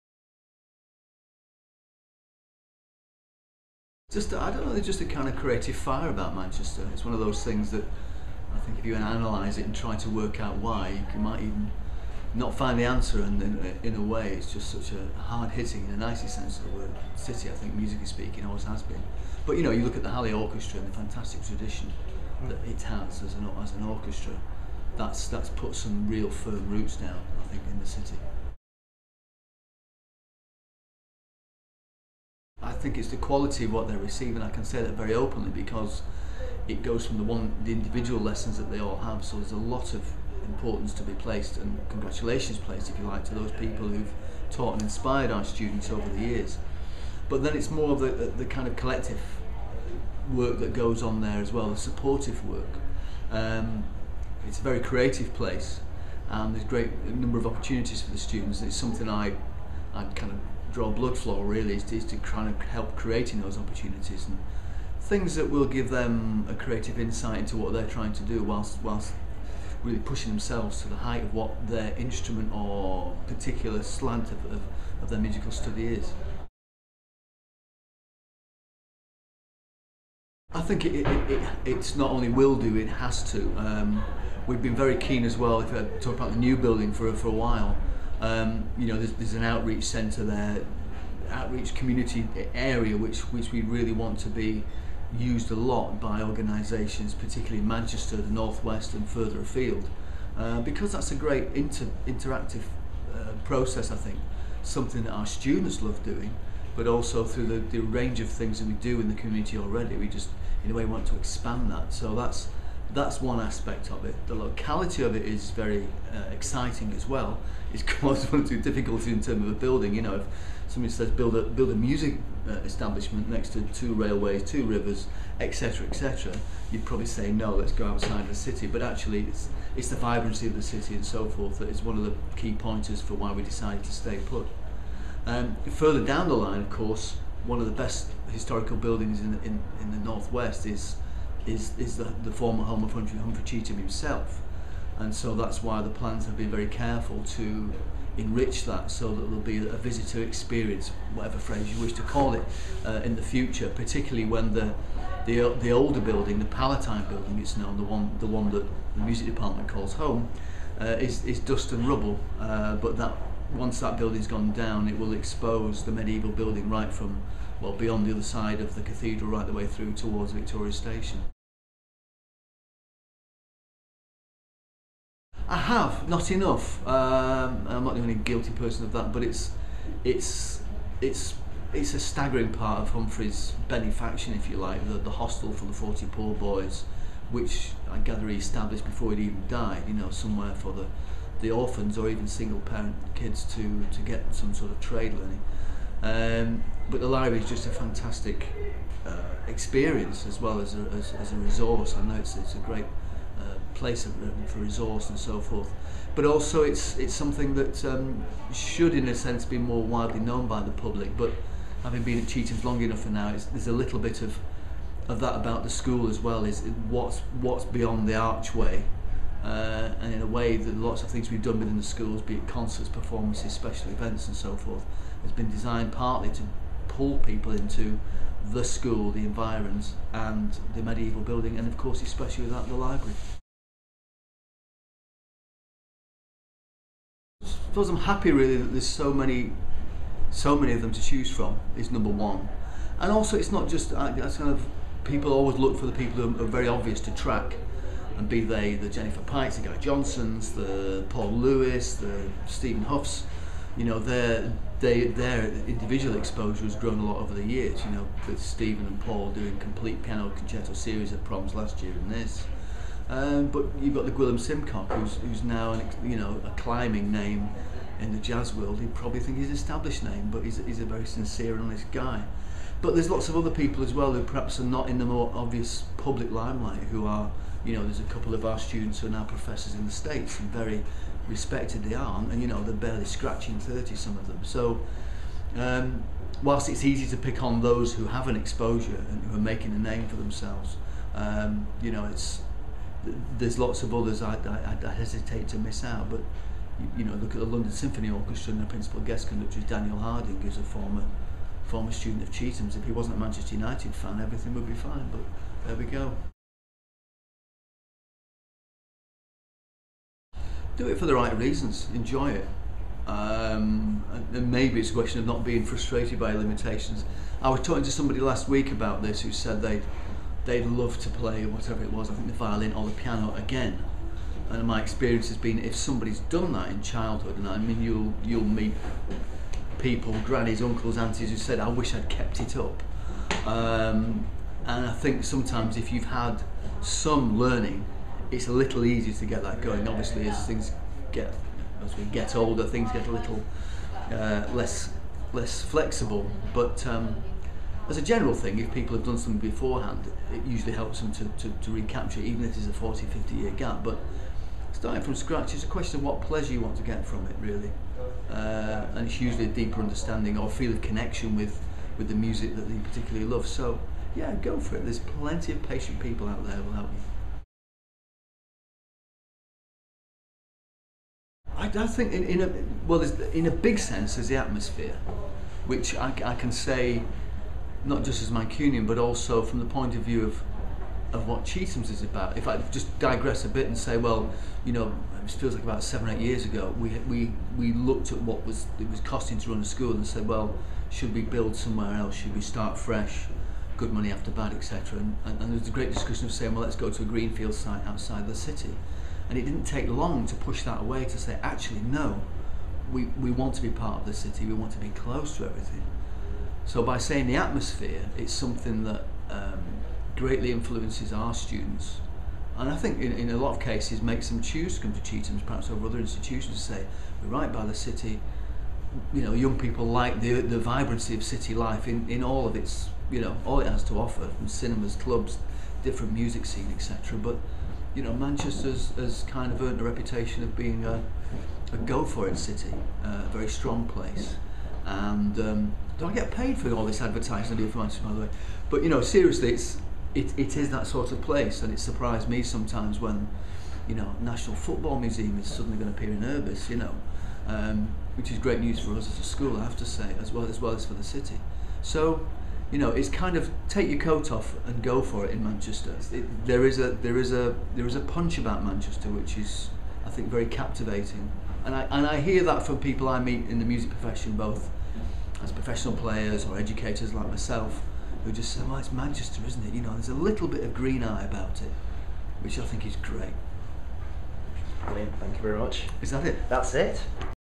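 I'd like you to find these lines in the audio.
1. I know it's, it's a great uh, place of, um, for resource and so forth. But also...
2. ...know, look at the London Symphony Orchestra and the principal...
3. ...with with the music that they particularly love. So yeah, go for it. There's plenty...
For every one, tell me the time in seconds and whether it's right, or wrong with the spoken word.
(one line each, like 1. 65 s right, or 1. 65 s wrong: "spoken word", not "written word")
1. 201 s right
2. 297 s right
3. 361 s right.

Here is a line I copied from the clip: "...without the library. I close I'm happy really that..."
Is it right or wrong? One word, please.
wrong.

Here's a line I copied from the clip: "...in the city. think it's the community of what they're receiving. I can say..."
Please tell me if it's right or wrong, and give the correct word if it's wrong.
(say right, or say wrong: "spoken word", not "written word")
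wrong: "quality", not "community".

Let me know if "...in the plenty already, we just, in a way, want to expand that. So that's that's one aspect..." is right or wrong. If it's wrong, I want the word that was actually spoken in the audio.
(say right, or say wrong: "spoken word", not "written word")
wrong: "community", not "plenty".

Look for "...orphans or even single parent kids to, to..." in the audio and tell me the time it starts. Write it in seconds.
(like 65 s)
191 s.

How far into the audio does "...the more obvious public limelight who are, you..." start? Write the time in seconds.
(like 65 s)
274 s.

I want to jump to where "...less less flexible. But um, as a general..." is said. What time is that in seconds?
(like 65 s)
344 s.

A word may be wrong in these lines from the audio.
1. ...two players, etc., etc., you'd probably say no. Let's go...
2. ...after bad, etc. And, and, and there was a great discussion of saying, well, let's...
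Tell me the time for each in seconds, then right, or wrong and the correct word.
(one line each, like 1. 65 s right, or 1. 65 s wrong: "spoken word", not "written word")
1. 124 s wrong: "rivers", not "players"
2. 394 s right.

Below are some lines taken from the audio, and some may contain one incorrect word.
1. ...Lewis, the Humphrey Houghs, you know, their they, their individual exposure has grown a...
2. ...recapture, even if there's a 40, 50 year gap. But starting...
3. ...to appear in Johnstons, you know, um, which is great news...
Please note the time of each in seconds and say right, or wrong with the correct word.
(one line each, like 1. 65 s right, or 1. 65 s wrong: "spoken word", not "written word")
1. 251 s wrong: "Stephen", not "Humphrey"
2. 351 s right
3. 445 s wrong: "Urbis", not "Johnstons".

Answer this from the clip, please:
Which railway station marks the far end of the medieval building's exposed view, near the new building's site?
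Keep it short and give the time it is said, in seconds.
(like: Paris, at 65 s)
Victoria Station, at 170 s.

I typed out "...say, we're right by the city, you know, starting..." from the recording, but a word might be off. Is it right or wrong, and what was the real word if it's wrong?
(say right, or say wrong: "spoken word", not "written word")
wrong: "young", not "starting".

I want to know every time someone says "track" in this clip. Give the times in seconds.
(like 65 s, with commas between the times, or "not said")
247 s.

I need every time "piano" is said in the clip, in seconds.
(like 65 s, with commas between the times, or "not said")
260 s, 322 s.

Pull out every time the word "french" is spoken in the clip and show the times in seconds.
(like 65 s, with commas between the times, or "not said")
not said.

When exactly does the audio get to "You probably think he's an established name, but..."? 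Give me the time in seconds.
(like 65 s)
268 s.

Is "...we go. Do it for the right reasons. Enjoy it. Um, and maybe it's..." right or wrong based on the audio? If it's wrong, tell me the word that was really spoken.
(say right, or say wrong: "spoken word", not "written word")
right.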